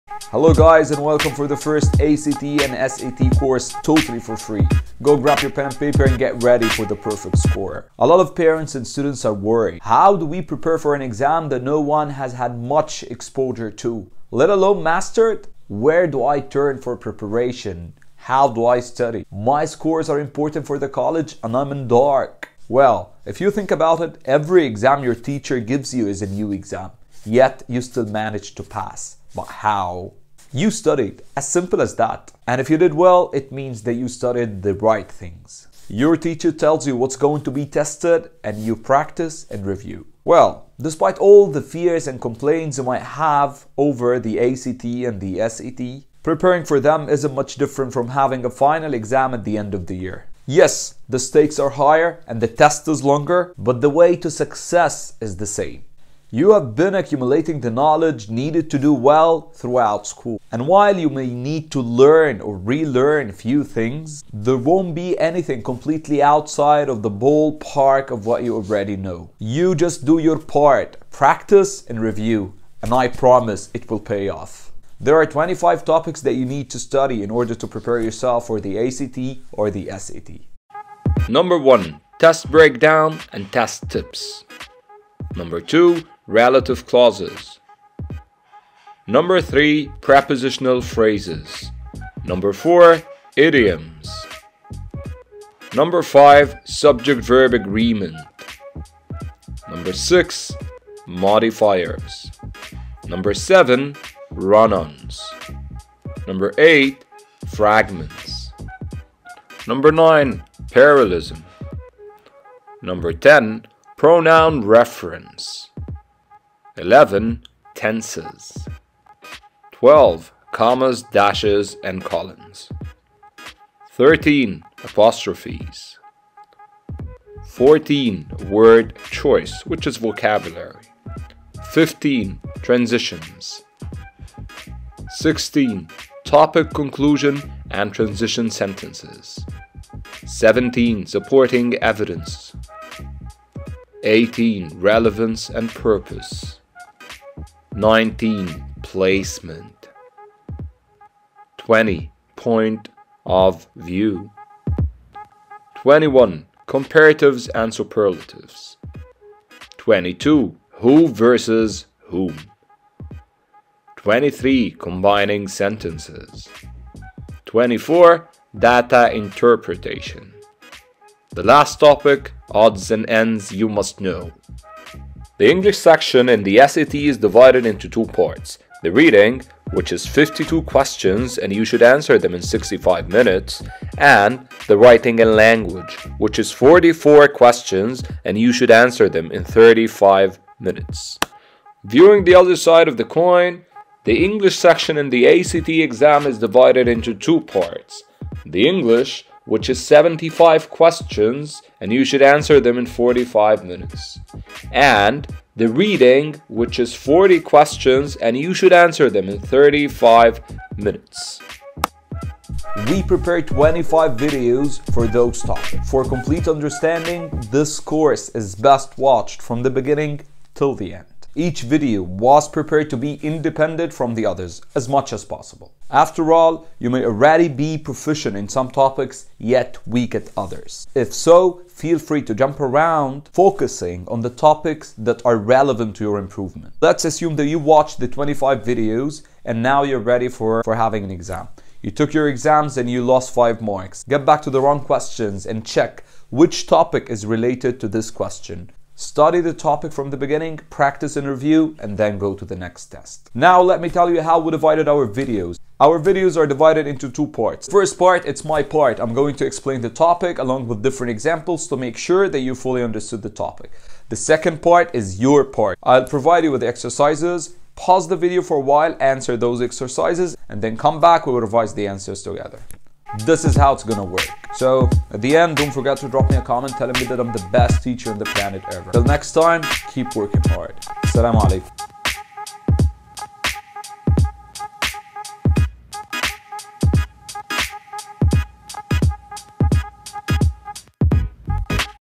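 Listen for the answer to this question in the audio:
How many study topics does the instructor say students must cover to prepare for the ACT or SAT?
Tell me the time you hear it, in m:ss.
1:15.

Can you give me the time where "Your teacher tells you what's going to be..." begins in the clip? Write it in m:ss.
0:35.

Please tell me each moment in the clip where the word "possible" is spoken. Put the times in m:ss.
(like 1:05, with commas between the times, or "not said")
3:45.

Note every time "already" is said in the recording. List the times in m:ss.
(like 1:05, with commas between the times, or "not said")
1:08, 3:47.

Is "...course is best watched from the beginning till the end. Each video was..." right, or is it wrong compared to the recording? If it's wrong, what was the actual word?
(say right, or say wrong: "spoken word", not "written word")
right.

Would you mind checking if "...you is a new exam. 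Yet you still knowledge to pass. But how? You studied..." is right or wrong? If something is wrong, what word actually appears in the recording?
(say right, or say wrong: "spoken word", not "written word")
wrong: "manage", not "knowledge".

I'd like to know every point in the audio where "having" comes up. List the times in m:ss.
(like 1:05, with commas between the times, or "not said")
0:48, 4:00.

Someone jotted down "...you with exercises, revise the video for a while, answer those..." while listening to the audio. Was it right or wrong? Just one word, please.
wrong.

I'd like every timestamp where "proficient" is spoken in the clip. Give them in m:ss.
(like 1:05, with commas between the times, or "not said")
3:47.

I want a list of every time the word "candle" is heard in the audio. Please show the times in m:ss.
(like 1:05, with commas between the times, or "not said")
not said.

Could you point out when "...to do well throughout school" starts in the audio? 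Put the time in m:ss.
0:58.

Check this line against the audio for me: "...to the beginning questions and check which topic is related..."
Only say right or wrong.
wrong.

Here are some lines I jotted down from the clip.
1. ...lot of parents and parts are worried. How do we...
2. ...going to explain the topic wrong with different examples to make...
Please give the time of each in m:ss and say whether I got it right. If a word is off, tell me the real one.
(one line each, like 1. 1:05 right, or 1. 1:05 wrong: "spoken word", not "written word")
1. 0:08 wrong: "students", not "parts"
2. 4:19 wrong: "along", not "wrong".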